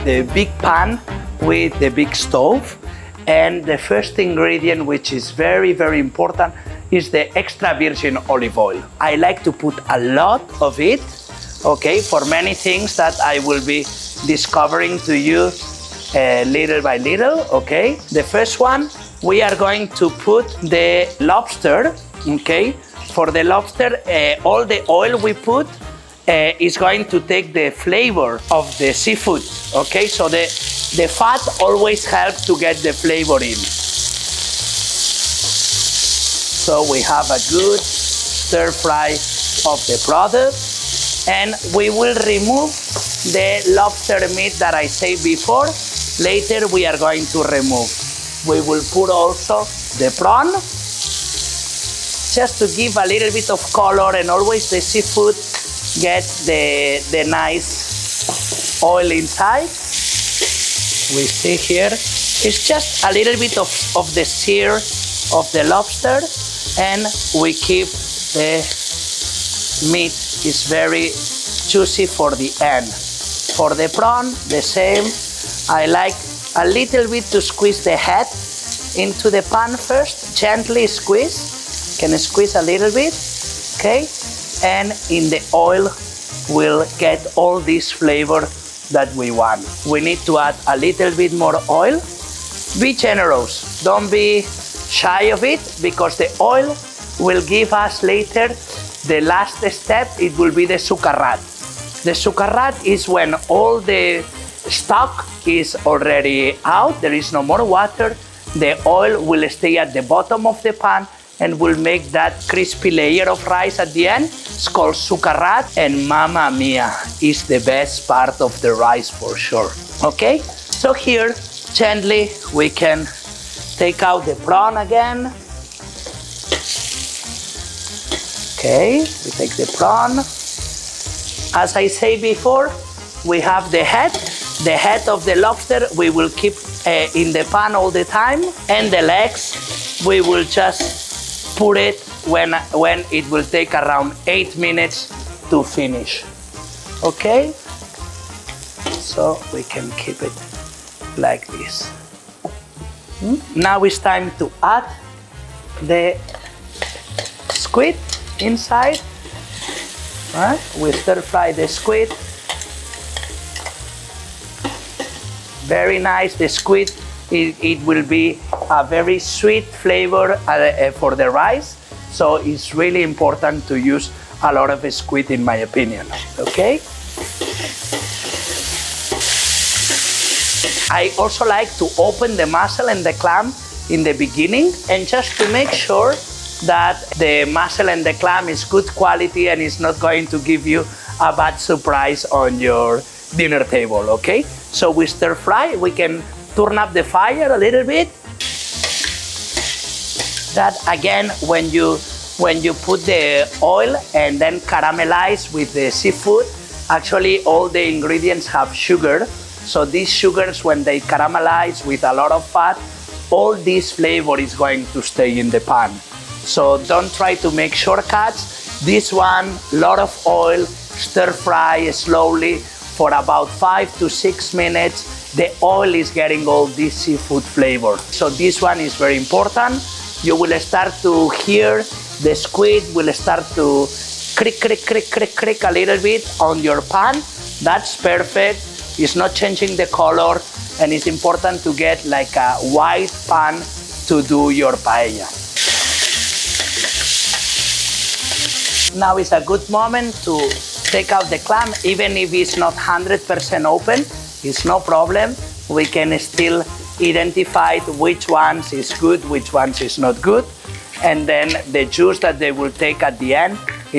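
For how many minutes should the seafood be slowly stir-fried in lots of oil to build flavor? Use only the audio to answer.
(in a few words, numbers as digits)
5 to 6.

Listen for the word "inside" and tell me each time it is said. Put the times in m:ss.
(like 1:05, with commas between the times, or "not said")
0:59, 2:38.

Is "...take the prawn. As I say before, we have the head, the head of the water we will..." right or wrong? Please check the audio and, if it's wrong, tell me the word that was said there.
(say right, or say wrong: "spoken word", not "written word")
wrong: "lobster", not "water".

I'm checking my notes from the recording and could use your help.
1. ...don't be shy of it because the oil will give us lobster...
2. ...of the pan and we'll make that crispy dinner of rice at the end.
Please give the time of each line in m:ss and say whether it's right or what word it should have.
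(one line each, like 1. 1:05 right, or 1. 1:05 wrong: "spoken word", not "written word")
1. 1:33 wrong: "later", not "lobster"
2. 1:50 wrong: "layer", not "dinner".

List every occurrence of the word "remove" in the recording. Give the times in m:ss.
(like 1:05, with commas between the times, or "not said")
0:42, 0:47.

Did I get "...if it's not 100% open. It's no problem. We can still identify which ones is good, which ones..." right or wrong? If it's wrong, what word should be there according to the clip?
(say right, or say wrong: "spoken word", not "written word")
right.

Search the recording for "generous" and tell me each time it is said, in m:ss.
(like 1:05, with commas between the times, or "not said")
1:32.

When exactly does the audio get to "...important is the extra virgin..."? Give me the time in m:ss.
0:05.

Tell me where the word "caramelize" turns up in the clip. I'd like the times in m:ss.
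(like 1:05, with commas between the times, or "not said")
3:24, 3:31.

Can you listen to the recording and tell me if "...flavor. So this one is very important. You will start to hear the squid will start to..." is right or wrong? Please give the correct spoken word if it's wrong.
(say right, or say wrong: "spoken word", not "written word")
right.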